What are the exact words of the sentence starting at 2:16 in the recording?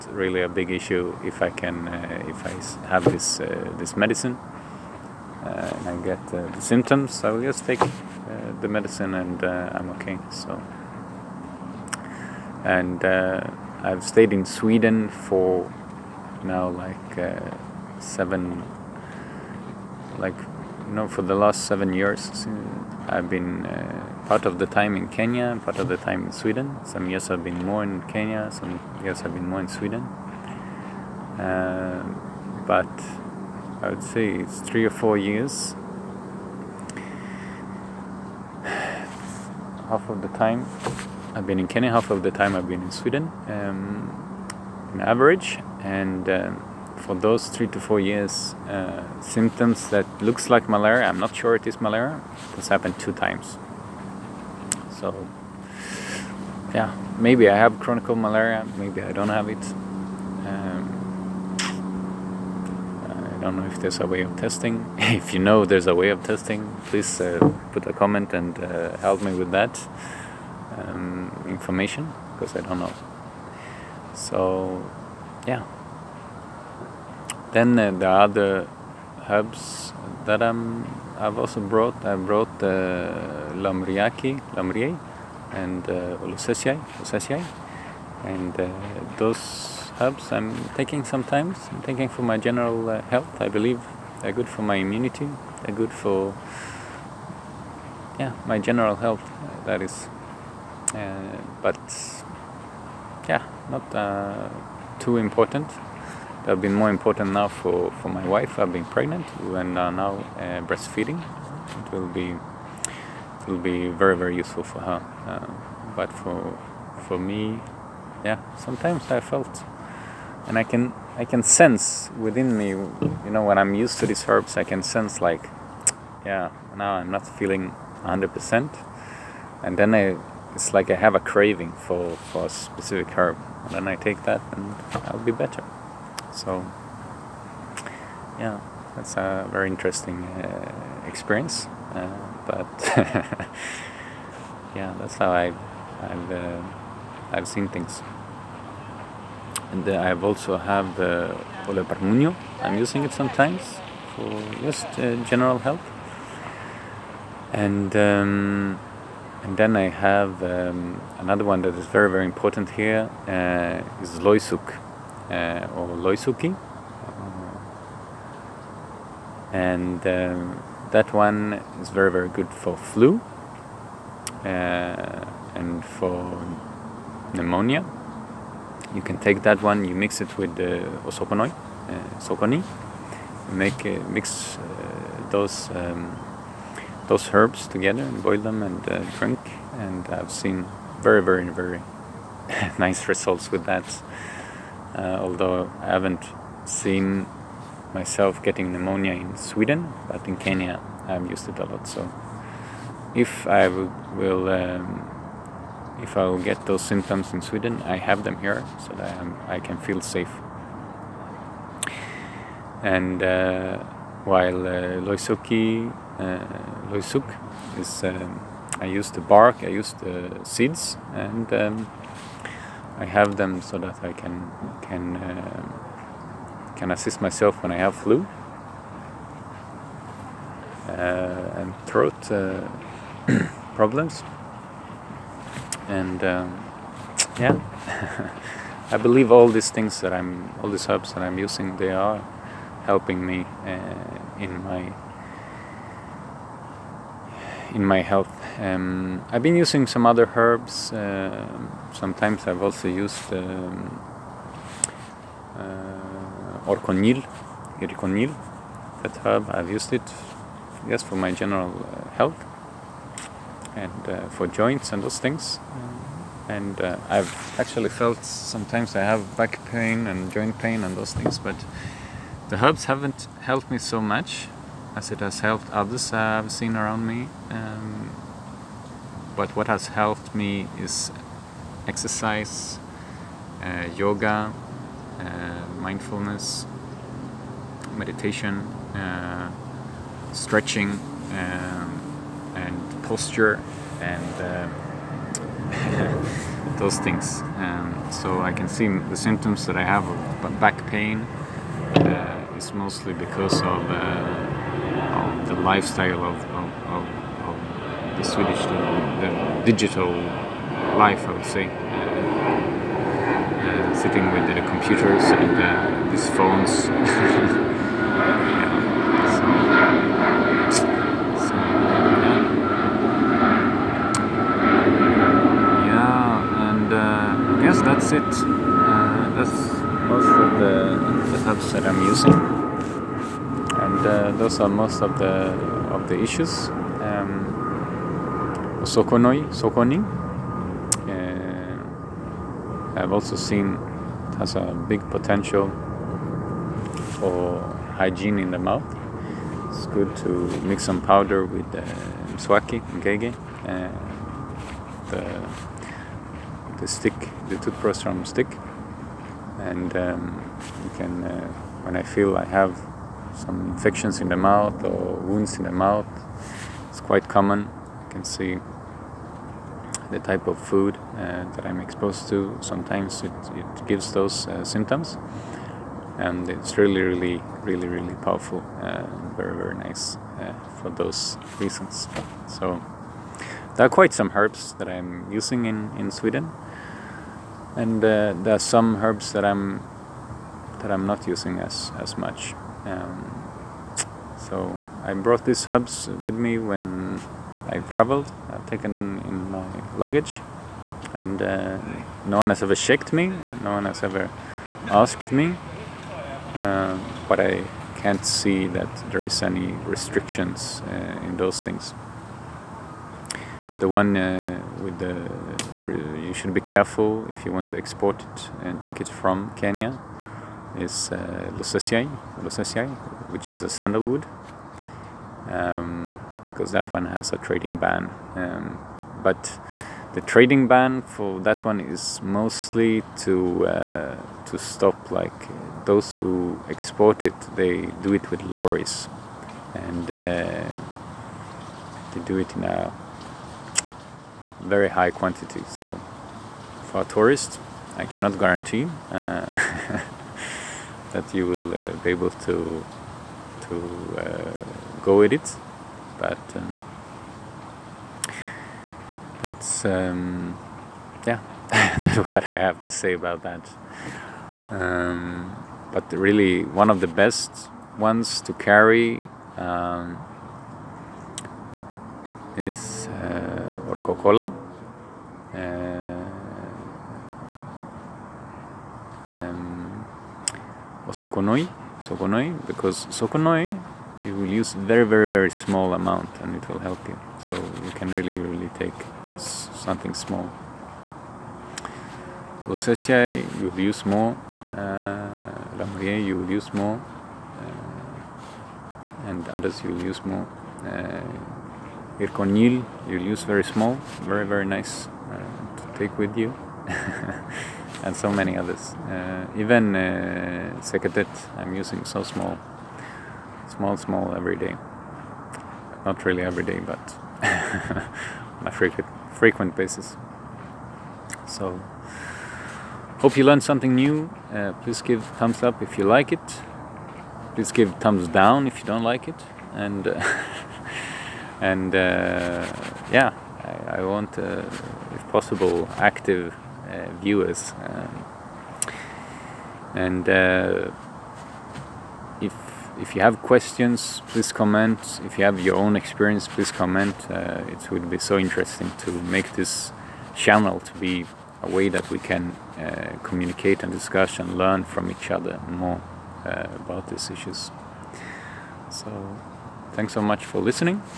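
So, yeah, that's a very interesting uh, experience.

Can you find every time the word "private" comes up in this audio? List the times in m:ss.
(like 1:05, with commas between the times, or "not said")
not said.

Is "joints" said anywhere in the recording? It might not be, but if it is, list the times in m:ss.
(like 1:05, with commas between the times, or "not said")
4:24, 4:30.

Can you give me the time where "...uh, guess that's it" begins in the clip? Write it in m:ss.
5:27.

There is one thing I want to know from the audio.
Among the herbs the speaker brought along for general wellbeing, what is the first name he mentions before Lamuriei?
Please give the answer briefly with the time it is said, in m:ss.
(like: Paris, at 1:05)
Lamuriaki, at 1:23.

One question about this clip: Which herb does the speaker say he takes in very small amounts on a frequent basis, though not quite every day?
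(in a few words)
Seketet.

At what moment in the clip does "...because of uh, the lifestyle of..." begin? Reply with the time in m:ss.
5:03.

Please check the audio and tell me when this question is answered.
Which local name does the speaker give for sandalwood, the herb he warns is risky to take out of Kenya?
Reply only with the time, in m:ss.
7:01.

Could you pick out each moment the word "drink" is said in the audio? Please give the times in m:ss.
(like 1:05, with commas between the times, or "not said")
3:09.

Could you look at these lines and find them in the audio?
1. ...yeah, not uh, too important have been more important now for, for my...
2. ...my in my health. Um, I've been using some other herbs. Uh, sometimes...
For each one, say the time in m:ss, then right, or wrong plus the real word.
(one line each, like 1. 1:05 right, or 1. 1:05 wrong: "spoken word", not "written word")
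1. 1:43 right
2. 4:04 right.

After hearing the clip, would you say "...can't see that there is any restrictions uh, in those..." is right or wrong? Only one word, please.
right.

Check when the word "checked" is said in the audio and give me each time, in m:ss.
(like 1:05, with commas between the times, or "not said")
6:42.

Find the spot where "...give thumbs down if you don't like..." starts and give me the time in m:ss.
8:47.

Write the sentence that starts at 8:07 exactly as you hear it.
So you can really really take something small.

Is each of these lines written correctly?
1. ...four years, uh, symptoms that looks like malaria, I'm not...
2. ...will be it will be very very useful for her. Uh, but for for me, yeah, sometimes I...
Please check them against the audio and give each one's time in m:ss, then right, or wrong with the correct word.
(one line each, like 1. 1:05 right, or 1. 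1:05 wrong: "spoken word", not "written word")
1. 0:47 right
2. 1:51 right.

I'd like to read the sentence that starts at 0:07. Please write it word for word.
I will just take the medicine and I'm okay.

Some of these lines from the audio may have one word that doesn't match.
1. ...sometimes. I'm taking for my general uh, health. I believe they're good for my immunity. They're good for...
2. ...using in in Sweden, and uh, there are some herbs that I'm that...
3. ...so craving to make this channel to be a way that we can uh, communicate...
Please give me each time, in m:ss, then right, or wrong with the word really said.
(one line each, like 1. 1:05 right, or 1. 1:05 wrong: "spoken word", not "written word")
1. 1:31 right
2. 6:25 right
3. 9:08 wrong: "interesting", not "craving".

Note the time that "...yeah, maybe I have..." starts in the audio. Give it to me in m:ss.
0:56.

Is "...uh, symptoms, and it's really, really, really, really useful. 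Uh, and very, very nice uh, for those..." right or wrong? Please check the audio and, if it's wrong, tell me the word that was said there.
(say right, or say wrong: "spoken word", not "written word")
wrong: "powerful", not "useful".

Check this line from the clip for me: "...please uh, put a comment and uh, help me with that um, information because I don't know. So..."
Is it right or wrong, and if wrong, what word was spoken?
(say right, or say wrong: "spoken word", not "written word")
right.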